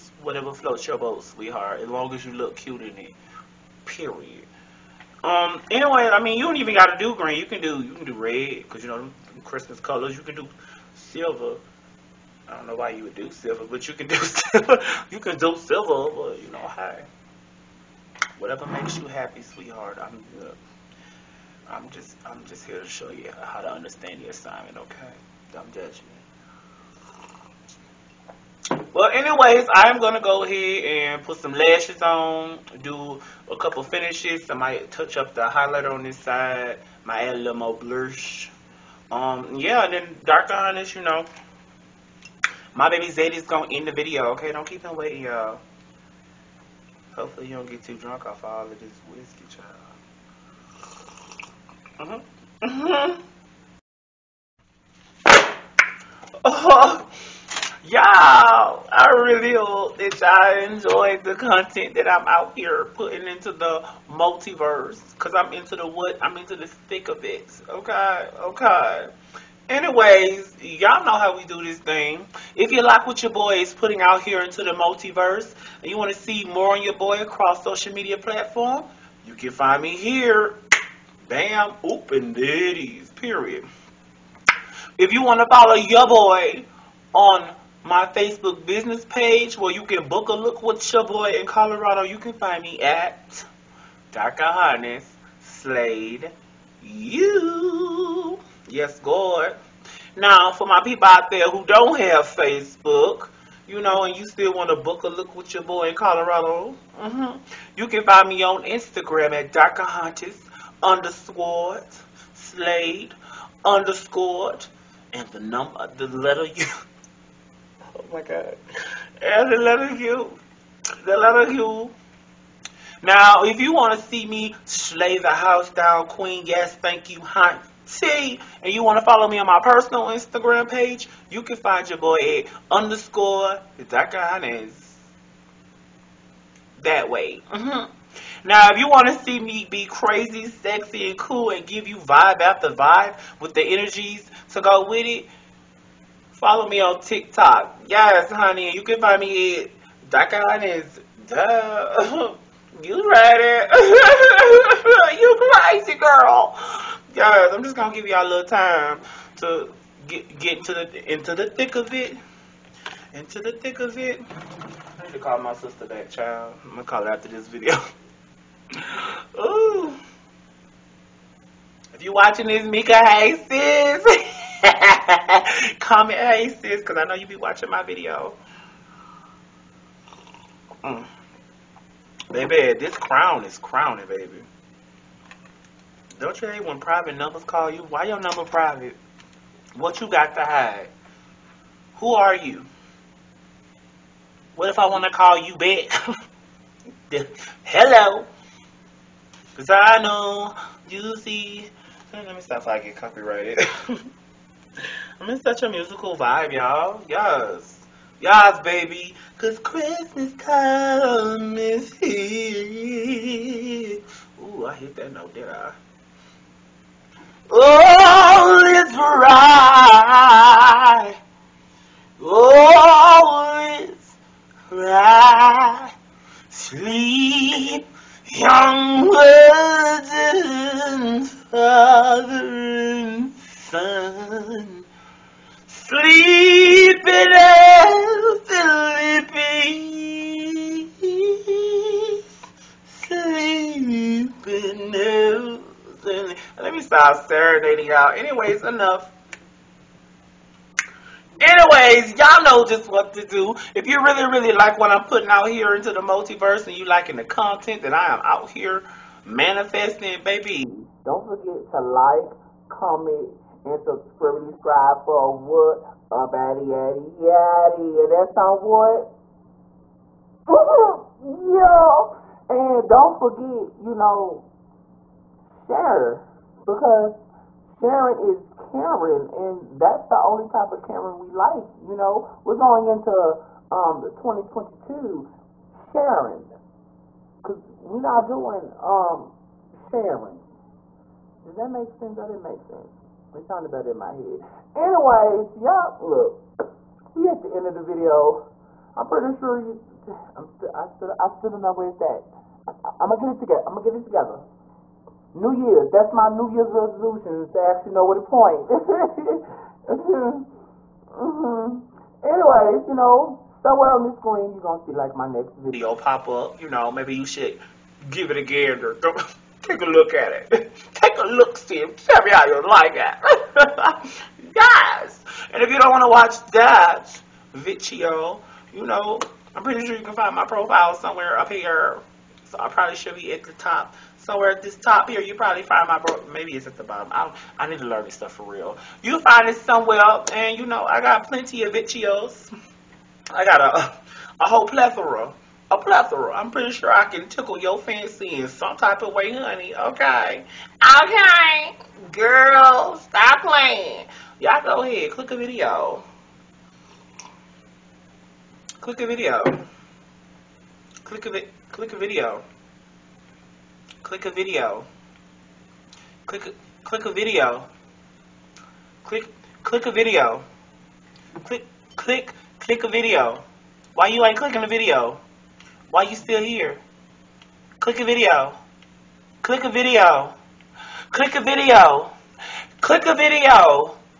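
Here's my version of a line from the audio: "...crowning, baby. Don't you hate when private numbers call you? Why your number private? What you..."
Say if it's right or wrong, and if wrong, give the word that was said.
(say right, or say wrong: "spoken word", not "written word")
right.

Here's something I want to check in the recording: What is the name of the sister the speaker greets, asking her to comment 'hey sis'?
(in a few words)
Mika.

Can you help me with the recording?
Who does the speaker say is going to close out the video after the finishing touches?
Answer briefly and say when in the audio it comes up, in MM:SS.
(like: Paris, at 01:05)
Zadie, at 00:43.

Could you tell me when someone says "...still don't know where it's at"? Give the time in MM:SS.
05:01.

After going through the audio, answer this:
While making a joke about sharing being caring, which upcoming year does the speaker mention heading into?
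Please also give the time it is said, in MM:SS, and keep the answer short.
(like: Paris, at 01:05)
2022, at 04:44.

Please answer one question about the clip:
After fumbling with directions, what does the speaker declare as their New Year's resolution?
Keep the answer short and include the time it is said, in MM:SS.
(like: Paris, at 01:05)
Know where to point, at 05:07.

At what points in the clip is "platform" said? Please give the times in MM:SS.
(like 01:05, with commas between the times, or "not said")
01:18.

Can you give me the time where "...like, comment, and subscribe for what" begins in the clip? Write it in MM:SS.
04:21.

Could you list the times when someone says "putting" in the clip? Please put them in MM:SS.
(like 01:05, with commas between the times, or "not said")
01:02, 01:13, 04:15.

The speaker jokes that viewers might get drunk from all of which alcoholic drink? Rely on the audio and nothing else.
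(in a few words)
Whiskey.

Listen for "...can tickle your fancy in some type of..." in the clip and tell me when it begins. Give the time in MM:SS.
05:47.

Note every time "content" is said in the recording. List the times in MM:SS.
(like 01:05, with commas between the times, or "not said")
01:01, 04:17.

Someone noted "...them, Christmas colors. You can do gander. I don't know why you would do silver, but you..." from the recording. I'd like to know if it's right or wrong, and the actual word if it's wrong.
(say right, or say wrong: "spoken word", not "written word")
wrong: "silver", not "gander".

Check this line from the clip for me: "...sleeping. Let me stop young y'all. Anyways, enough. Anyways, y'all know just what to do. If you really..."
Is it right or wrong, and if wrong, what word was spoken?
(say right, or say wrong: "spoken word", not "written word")
wrong: "serenading", not "young".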